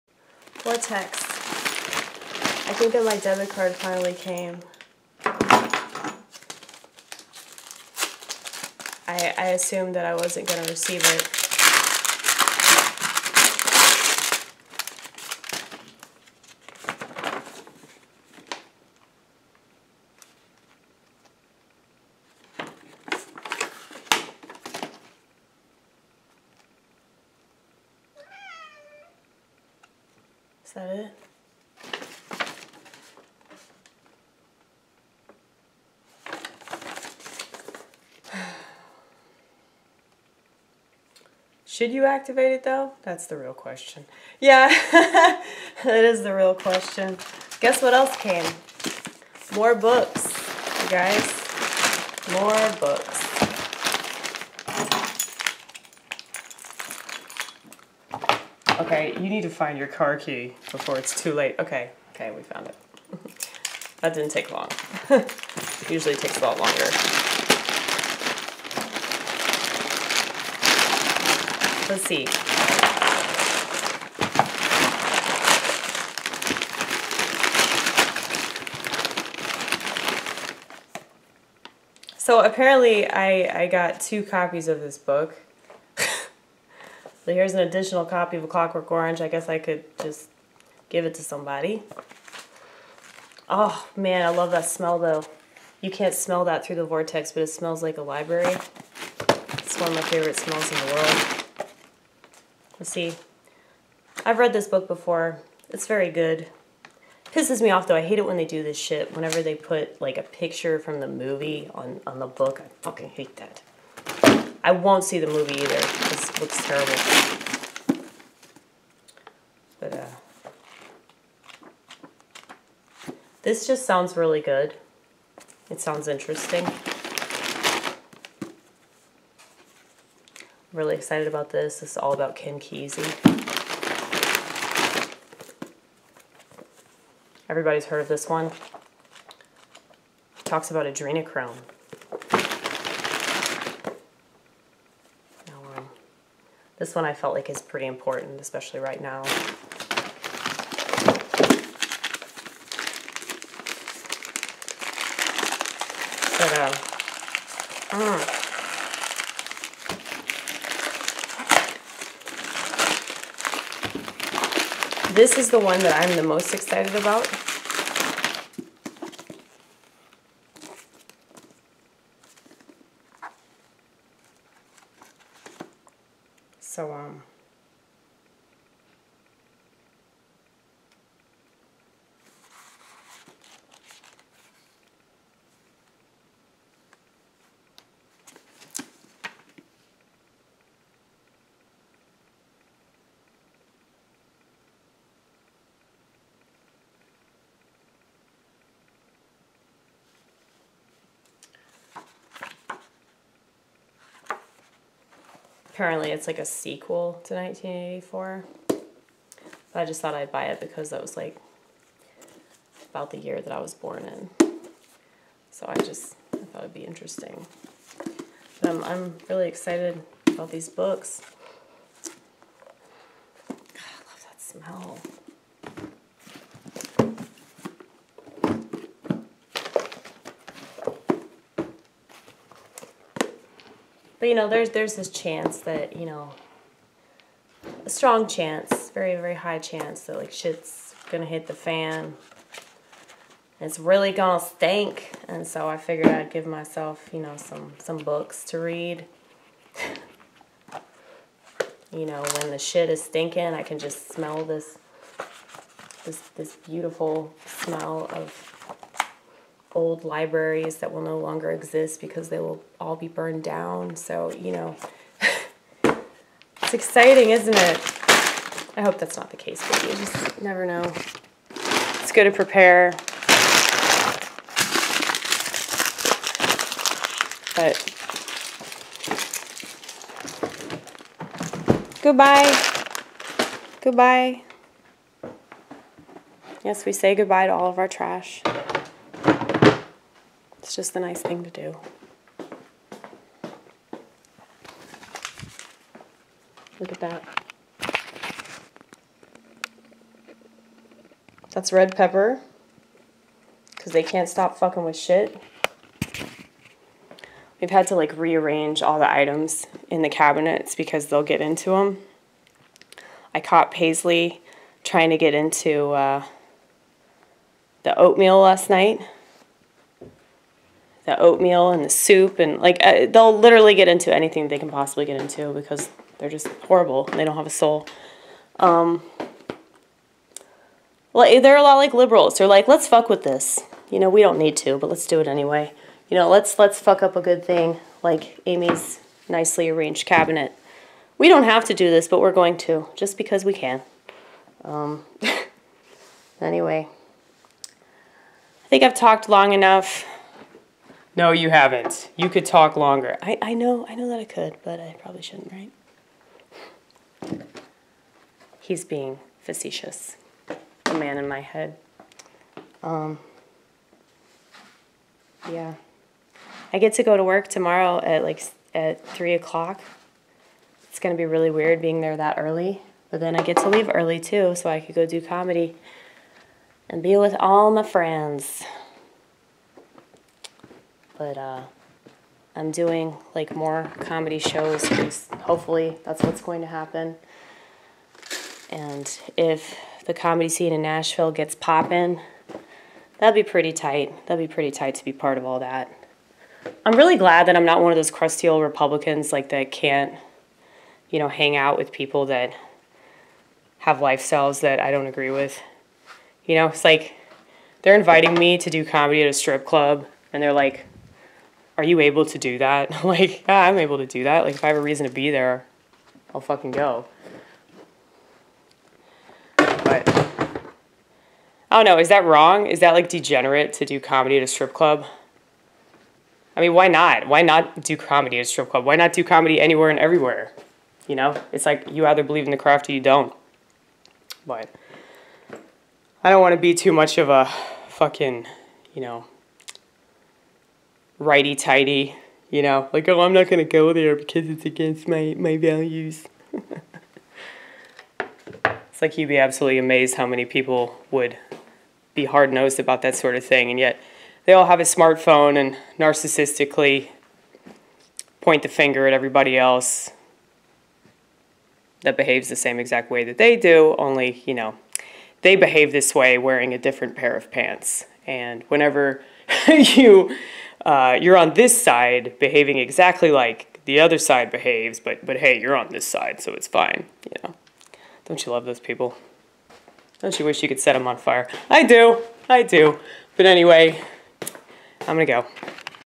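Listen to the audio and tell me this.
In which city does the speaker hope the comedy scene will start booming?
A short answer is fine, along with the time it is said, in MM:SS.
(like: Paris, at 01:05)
Nashville, at 06:30.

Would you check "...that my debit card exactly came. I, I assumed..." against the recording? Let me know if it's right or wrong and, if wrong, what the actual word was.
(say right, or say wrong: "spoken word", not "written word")
wrong: "finally", not "exactly".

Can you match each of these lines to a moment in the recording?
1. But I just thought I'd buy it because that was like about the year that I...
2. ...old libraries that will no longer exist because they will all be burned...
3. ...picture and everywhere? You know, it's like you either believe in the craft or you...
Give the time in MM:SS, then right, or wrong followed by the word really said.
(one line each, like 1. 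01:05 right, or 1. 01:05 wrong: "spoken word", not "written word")
1. 03:28 right
2. 04:19 right
3. 07:09 wrong: "anywhere", not "picture".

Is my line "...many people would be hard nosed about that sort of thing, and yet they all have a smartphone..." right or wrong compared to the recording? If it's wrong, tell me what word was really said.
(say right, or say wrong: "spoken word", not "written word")
right.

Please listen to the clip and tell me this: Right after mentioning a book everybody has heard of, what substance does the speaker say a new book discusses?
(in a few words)
adrenochrome.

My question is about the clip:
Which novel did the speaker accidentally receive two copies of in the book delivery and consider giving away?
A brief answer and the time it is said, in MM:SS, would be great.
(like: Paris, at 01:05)
A Clockwork Orange, at 01:28.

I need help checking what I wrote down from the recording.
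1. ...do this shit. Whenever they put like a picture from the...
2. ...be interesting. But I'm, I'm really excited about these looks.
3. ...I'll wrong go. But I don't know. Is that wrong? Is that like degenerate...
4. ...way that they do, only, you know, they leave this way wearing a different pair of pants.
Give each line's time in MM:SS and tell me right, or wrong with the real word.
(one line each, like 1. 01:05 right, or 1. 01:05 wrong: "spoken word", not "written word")
1. 01:48 right
2. 03:36 wrong: "books", not "looks"
3. 06:56 wrong: "fucking", not "wrong"
4. 07:43 wrong: "behave", not "leave".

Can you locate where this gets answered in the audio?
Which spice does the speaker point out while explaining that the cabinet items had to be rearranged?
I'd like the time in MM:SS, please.
05:01.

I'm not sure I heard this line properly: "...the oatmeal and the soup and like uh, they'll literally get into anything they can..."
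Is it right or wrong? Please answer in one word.
right.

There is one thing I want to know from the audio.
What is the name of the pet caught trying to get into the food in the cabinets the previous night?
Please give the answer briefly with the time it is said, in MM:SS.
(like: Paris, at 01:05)
Paisley, at 05:13.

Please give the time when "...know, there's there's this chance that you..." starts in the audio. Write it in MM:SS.
03:54.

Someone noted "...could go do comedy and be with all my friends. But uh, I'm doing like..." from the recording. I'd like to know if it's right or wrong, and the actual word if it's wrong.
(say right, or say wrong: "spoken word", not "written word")
right.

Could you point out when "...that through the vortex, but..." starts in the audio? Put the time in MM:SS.
01:36.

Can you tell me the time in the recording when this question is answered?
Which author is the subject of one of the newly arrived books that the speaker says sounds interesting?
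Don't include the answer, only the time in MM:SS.
02:12.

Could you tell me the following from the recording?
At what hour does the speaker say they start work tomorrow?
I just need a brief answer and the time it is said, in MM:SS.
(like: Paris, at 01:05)
3 o'clock, at 06:09.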